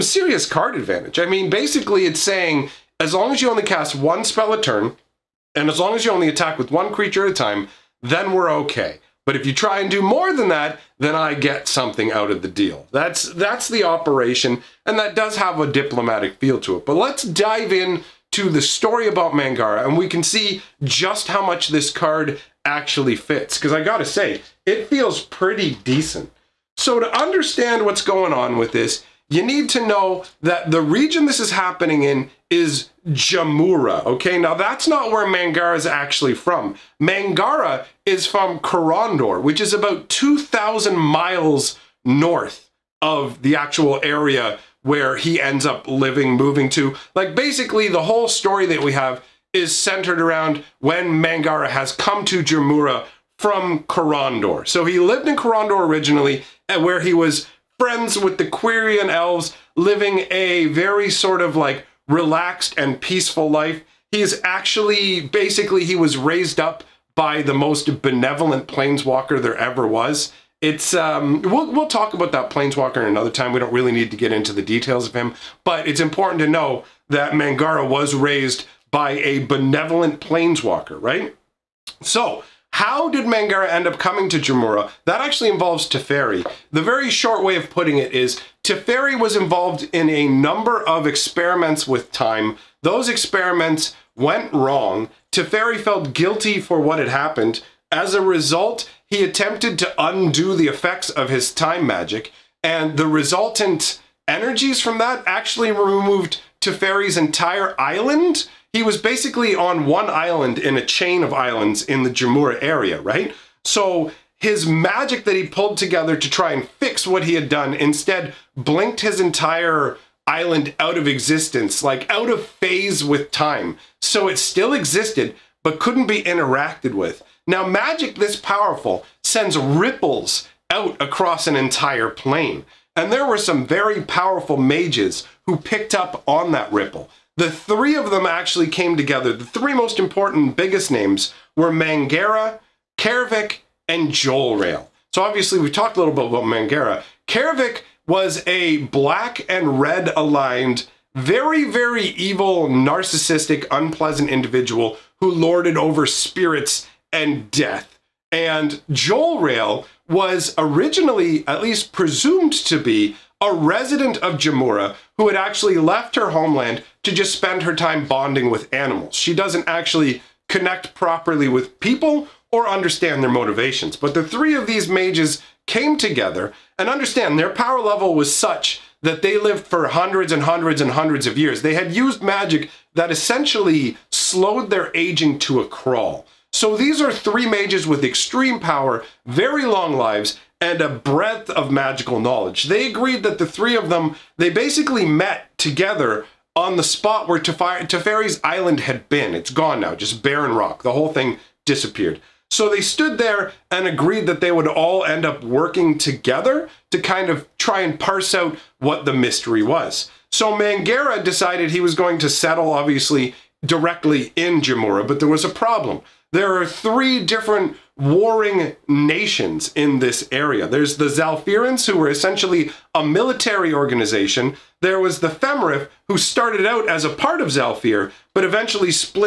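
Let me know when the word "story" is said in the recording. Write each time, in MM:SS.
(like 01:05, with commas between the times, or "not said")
00:18, 00:48.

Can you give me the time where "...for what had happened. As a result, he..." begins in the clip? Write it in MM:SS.
01:36.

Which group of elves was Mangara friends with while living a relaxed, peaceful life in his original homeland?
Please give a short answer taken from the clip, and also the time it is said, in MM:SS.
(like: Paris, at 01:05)
Quirion elves, at 00:58.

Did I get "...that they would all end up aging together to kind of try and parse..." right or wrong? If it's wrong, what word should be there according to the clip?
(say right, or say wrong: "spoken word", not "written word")
wrong: "working", not "aging".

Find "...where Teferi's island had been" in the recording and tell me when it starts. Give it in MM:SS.
03:17.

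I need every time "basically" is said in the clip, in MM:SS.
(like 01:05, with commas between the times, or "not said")
00:01, 00:47, 01:05, 01:48, 03:14.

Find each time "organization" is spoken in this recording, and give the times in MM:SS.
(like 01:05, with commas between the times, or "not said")
03:43.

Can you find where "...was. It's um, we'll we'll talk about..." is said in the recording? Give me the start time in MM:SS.
01:09.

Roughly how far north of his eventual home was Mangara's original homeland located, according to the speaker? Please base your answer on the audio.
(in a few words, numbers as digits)
2,000 miles.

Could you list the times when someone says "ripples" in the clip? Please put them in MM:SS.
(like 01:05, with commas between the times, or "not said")
02:09, 02:16.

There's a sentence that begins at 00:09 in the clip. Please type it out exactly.
But if you try and do more than that, then I get something out of the deal.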